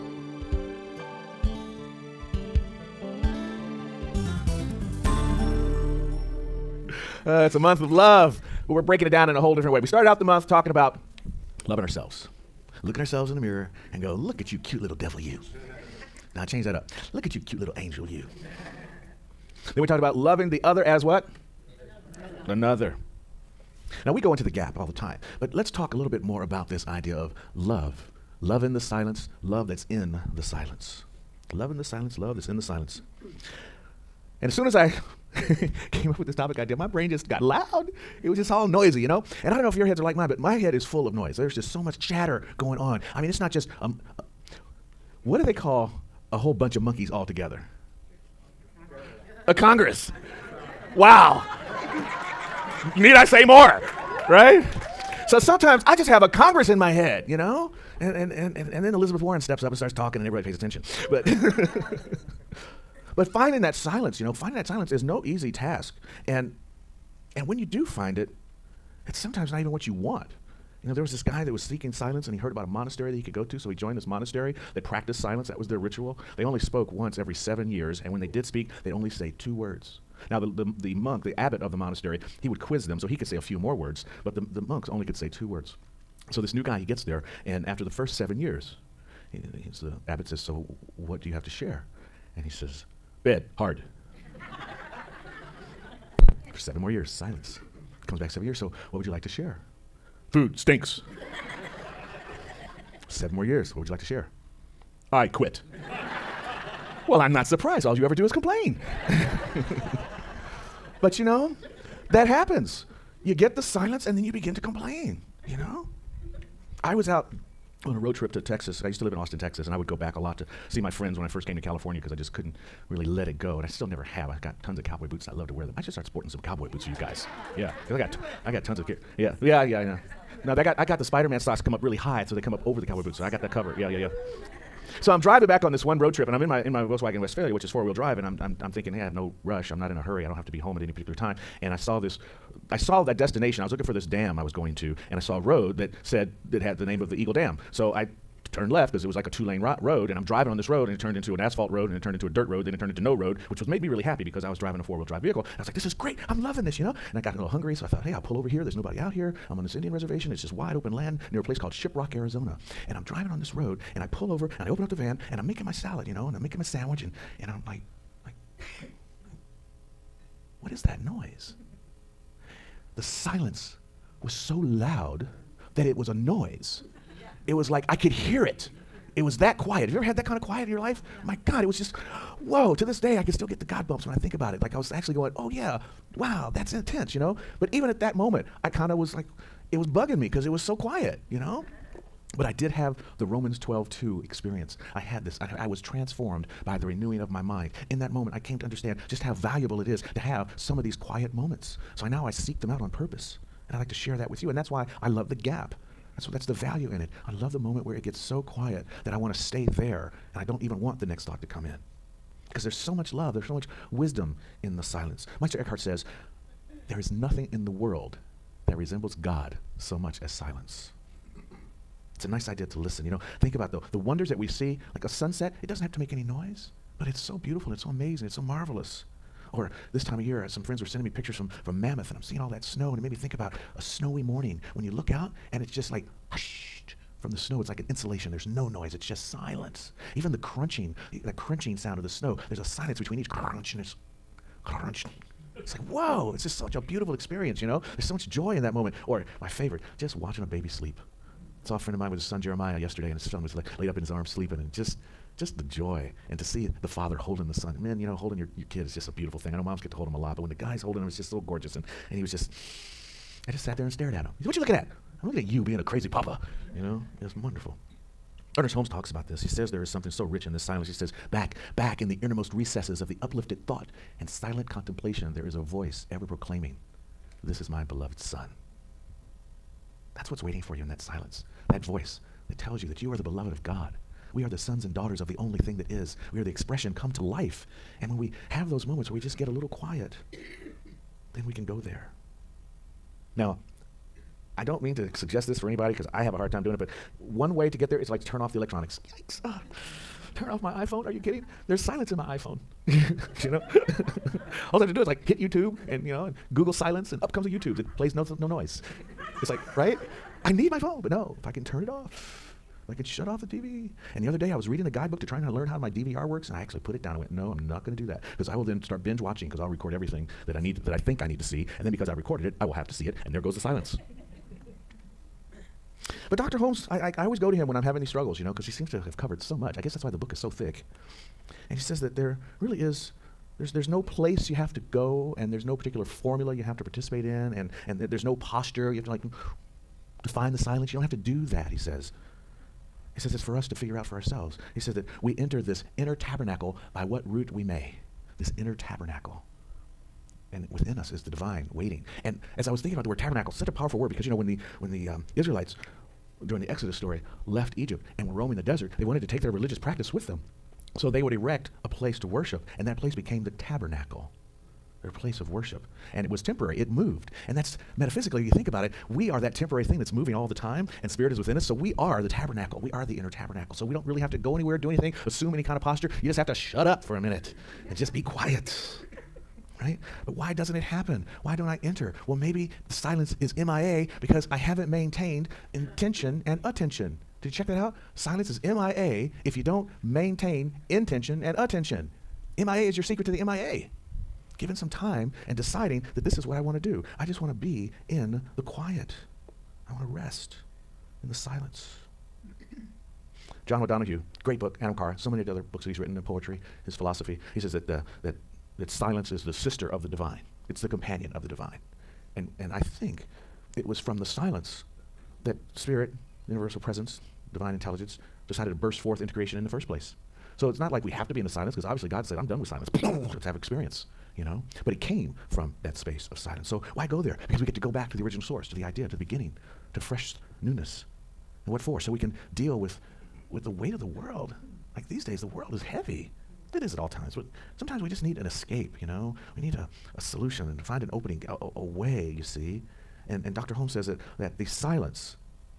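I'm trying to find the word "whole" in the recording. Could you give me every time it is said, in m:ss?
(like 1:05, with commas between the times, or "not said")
0:09, 0:46.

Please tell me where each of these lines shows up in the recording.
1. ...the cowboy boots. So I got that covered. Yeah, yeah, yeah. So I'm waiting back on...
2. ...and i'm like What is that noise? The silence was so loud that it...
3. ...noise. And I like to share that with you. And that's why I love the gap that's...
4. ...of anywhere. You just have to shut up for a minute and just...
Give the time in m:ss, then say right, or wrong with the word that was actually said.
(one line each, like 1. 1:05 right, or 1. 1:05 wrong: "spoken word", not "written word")
1. 2:12 wrong: "driving", not "waiting"
2. 2:47 right
3. 3:22 wrong: "purpose", not "noise"
4. 6:15 wrong: "posture", not "anywhere".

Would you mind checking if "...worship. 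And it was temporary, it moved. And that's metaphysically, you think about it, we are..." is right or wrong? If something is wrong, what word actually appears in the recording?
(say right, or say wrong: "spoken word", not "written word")
right.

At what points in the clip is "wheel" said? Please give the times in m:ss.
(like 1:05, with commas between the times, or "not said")
2:17, 2:34.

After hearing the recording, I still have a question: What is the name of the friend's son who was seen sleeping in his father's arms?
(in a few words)
Jeremiah.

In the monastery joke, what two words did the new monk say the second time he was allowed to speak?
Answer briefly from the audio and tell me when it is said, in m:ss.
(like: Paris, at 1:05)
Food stinks, at 1:40.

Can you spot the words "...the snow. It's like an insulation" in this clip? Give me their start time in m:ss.
3:57.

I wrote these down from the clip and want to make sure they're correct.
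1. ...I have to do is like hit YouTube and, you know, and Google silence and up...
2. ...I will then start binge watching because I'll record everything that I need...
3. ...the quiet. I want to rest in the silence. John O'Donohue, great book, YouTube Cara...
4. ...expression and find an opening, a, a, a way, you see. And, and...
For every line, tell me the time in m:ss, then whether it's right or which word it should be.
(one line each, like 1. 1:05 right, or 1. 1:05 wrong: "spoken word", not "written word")
1. 5:04 right
2. 5:18 right
3. 6:38 wrong: "Anam", not "YouTube"
4. 7:20 wrong: "solution", not "expression".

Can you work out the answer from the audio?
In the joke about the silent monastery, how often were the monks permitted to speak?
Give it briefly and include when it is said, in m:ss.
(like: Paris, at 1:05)
Once every 7 years, at 1:16.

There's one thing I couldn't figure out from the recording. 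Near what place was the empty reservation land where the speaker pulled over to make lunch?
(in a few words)
Shiprock.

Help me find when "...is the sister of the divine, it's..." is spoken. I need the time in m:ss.
6:49.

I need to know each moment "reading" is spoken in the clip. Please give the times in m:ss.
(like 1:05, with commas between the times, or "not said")
5:14.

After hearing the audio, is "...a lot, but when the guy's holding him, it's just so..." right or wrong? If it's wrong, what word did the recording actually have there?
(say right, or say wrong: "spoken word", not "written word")
right.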